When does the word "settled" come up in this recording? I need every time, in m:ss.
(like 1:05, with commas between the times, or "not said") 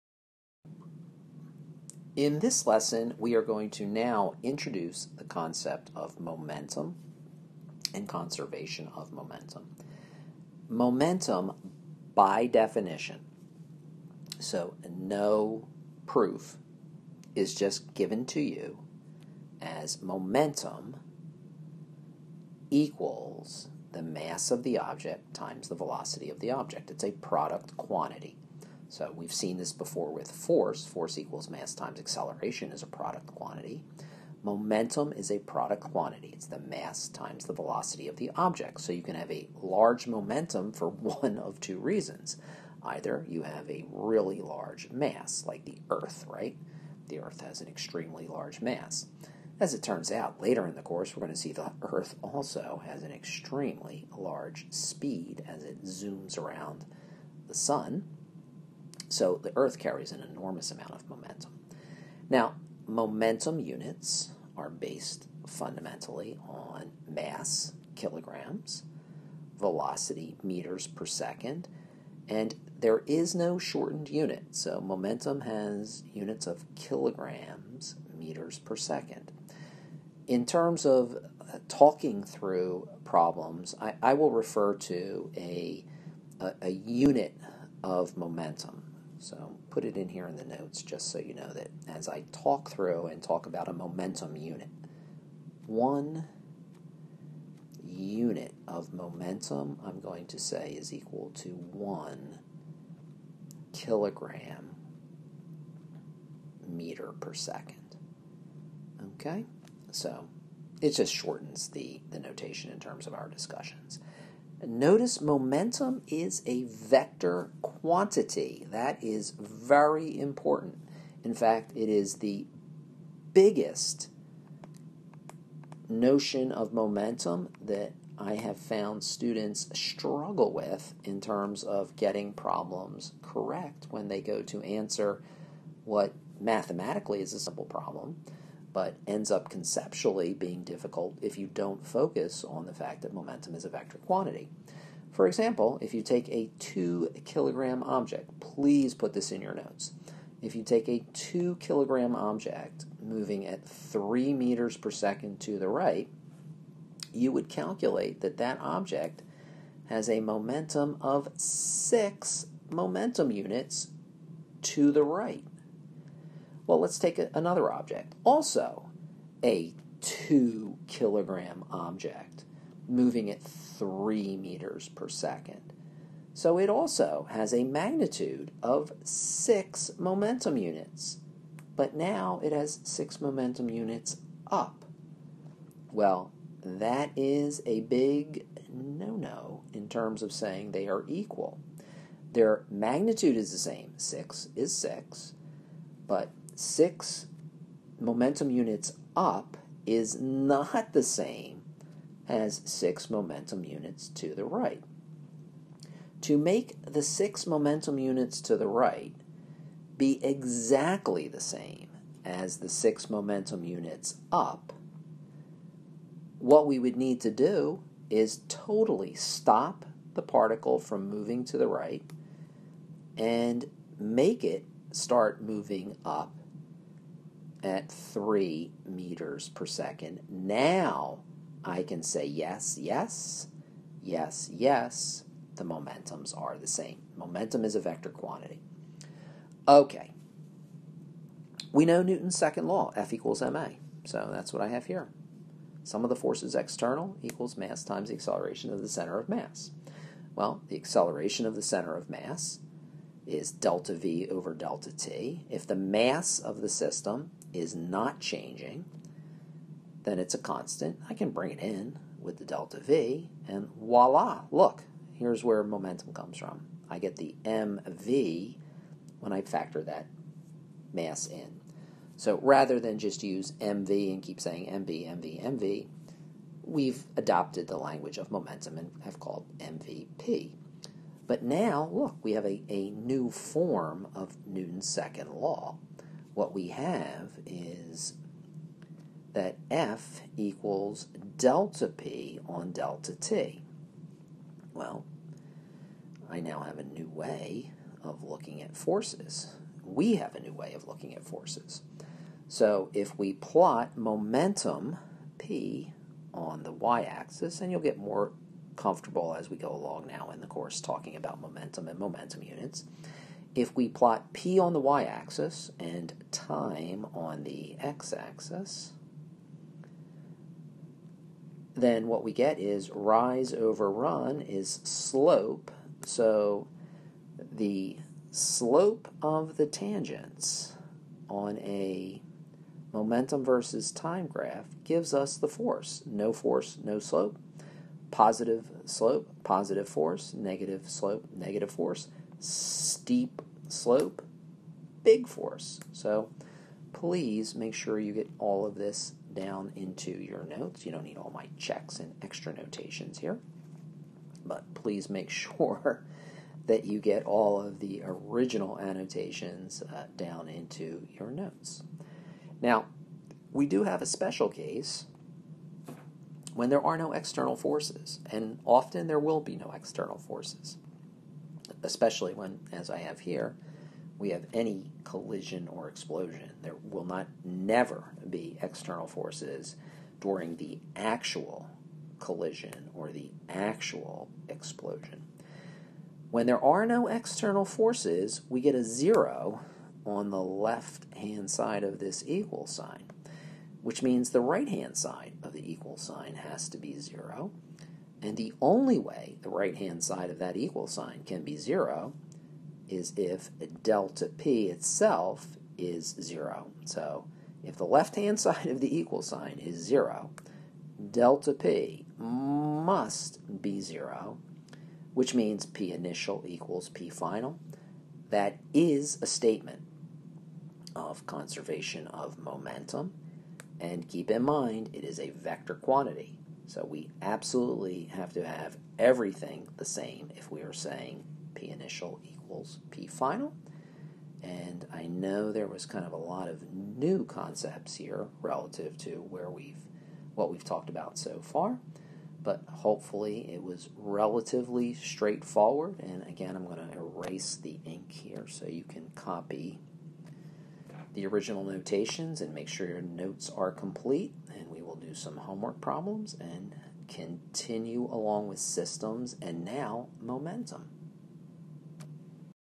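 not said.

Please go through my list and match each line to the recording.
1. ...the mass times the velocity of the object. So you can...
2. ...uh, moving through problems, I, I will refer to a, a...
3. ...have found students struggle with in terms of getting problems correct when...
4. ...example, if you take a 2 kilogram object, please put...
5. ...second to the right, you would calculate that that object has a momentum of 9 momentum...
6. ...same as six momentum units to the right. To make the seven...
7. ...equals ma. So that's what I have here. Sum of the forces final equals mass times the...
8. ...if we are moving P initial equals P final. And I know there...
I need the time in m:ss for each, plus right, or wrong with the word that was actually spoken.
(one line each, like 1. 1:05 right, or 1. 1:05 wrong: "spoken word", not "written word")
1. 0:36 right
2. 1:21 wrong: "talking", not "moving"
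3. 2:08 right
4. 2:25 right
5. 2:34 wrong: "6", not "9"
6. 3:21 wrong: "six", not "seven"
7. 4:03 wrong: "external", not "final"
8. 7:10 wrong: "saying", not "moving".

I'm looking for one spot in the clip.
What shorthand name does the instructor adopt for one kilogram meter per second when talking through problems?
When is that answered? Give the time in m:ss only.
1:33.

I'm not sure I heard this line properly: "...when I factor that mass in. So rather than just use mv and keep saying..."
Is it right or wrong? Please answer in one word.
right.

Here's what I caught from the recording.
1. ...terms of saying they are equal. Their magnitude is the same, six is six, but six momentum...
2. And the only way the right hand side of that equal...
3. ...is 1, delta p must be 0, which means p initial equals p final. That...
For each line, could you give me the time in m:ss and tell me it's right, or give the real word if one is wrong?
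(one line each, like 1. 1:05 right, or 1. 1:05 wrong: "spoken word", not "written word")
1. 3:09 right
2. 6:38 right
3. 6:49 wrong: "0", not "1".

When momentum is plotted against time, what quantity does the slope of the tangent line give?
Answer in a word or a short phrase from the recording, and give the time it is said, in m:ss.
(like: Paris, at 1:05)
the force, at 5:35.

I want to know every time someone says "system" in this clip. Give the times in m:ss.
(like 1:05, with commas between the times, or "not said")
4:16, 7:38.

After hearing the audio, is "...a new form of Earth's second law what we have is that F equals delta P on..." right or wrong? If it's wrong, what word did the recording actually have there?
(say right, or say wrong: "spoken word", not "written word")
wrong: "Newton", not "Earth".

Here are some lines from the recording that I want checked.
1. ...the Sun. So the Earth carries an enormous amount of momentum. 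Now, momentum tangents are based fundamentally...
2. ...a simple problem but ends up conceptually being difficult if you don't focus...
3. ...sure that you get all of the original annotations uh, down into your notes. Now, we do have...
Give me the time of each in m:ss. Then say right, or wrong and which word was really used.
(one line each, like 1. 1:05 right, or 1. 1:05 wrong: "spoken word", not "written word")
1. 0:57 wrong: "units", not "tangents"
2. 2:17 right
3. 5:55 right.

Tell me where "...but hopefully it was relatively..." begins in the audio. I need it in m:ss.
7:22.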